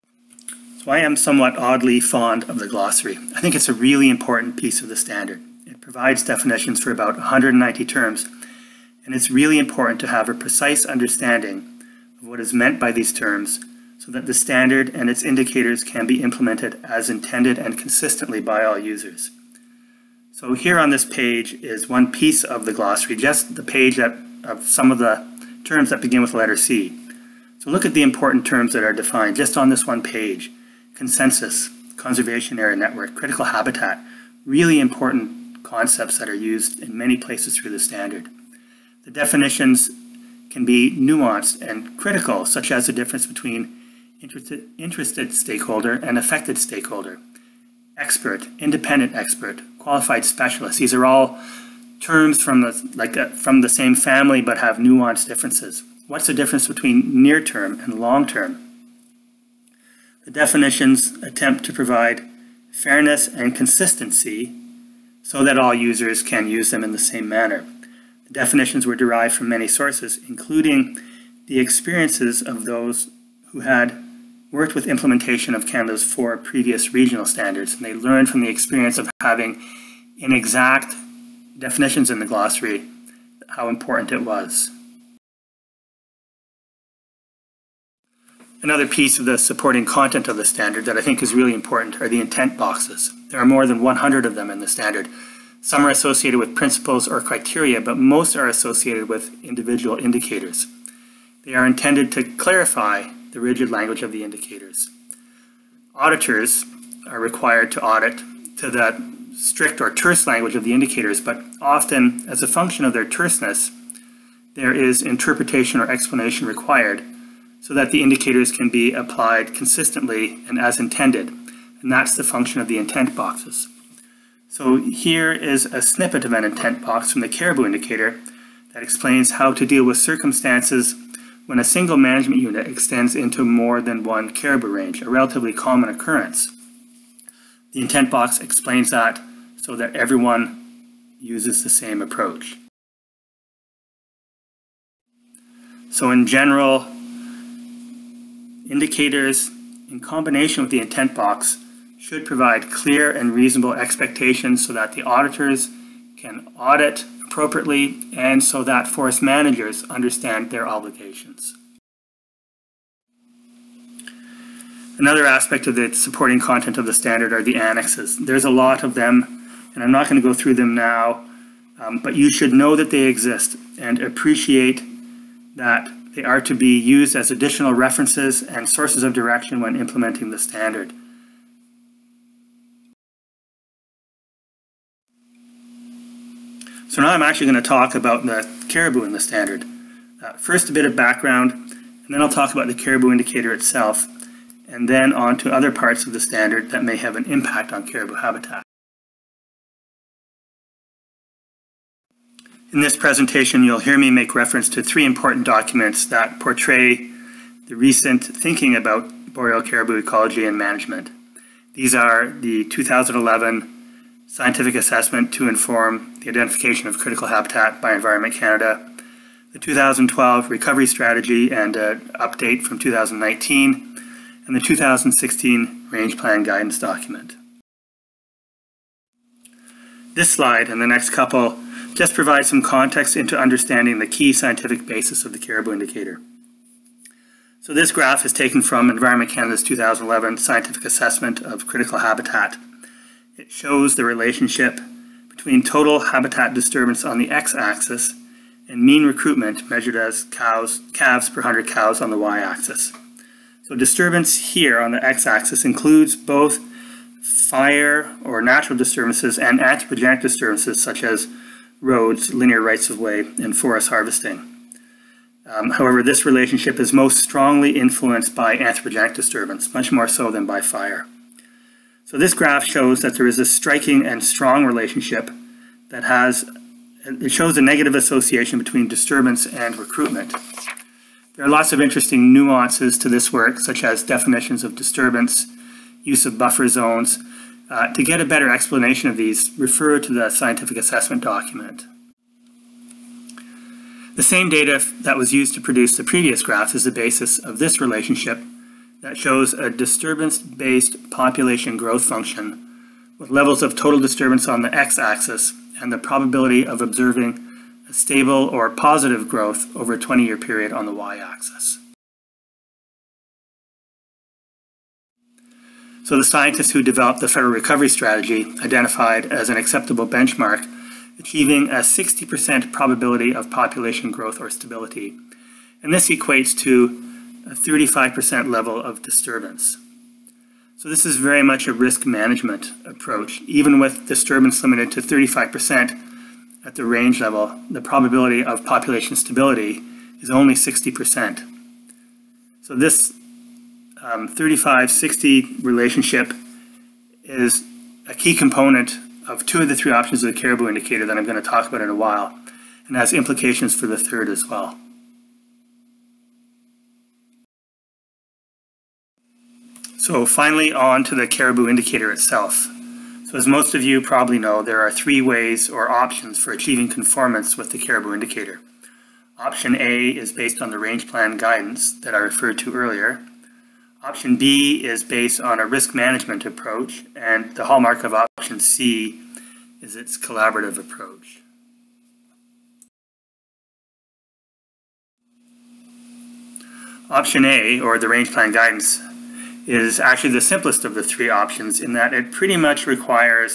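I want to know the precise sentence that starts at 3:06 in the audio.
So now I'm actually going to talk about the caribou in the standard.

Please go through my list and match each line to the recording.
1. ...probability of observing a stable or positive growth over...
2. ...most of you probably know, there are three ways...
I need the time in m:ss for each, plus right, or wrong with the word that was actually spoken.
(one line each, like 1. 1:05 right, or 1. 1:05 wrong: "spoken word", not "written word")
1. 5:05 right
2. 6:03 right.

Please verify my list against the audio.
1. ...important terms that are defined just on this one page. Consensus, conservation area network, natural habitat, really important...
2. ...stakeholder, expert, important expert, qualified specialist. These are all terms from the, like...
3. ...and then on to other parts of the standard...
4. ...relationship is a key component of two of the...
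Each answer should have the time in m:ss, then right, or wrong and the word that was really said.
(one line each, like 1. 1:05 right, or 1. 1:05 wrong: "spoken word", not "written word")
1. 0:28 wrong: "critical", not "natural"
2. 0:46 wrong: "independent", not "important"
3. 3:14 right
4. 5:45 right.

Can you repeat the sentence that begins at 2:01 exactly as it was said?
And that's the function of the intent boxes.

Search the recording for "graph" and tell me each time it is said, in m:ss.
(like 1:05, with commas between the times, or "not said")
3:57, 4:32, 4:56.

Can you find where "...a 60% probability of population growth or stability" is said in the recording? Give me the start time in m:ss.
5:21.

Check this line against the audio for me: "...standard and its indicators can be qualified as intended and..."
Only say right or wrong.
wrong.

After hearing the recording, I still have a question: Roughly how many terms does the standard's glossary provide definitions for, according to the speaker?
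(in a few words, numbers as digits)
190.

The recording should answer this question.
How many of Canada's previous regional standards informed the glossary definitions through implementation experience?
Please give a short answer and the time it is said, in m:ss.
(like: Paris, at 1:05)
4, at 1:16.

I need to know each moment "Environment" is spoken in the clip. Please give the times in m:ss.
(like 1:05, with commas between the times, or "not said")
3:37, 3:58.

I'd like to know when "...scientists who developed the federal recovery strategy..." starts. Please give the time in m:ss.
5:16.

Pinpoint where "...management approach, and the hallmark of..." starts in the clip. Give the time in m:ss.
6:15.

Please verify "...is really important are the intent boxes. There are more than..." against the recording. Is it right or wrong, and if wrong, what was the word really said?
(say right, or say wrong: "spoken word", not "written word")
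right.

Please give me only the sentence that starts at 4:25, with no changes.
Um, however, this relationship is most strongly influenced by anthropogenic disturbance, much more so than by fire.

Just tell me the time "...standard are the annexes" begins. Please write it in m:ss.
2:46.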